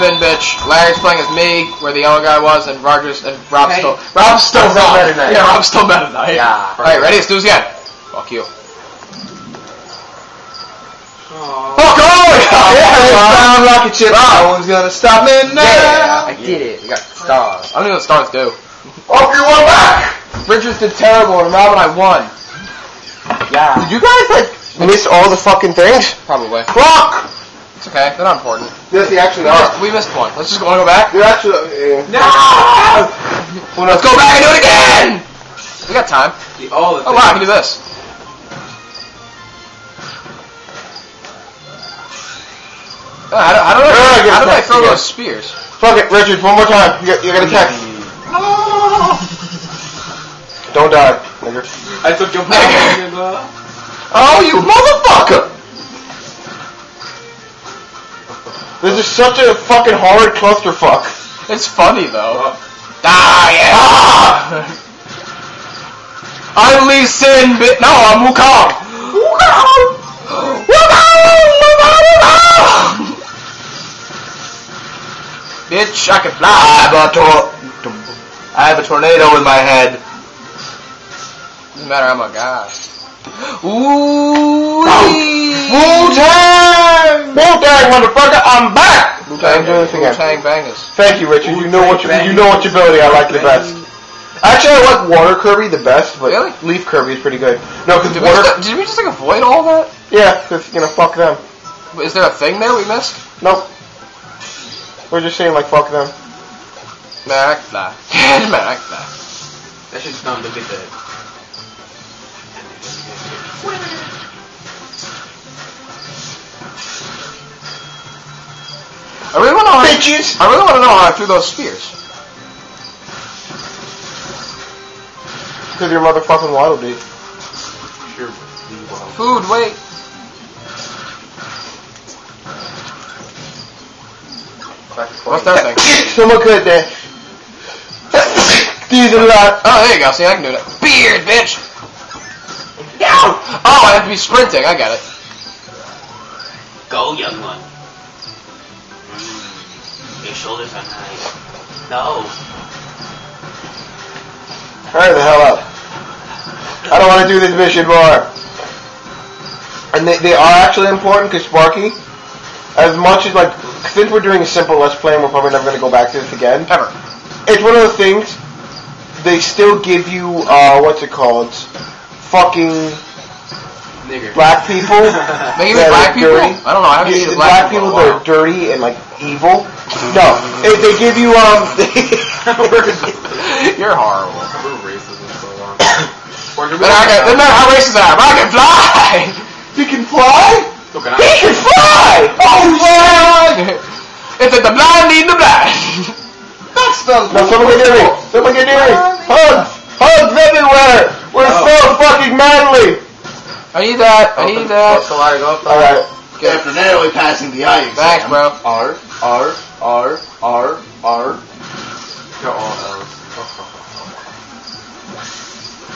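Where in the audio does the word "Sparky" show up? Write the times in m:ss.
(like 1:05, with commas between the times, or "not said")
2:41.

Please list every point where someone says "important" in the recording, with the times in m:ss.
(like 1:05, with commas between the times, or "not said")
0:28, 2:40.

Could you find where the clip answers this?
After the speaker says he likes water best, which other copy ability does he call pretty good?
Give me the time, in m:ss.
1:36.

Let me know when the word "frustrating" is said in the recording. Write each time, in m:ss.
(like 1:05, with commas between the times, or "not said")
not said.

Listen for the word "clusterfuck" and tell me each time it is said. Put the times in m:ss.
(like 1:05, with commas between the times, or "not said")
1:00.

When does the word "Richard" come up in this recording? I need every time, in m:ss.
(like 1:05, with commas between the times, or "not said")
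0:20, 0:46, 1:31.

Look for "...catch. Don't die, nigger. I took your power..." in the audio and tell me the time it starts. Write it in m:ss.
0:47.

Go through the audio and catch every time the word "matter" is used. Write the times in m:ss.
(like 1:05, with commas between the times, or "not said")
1:21, 3:07.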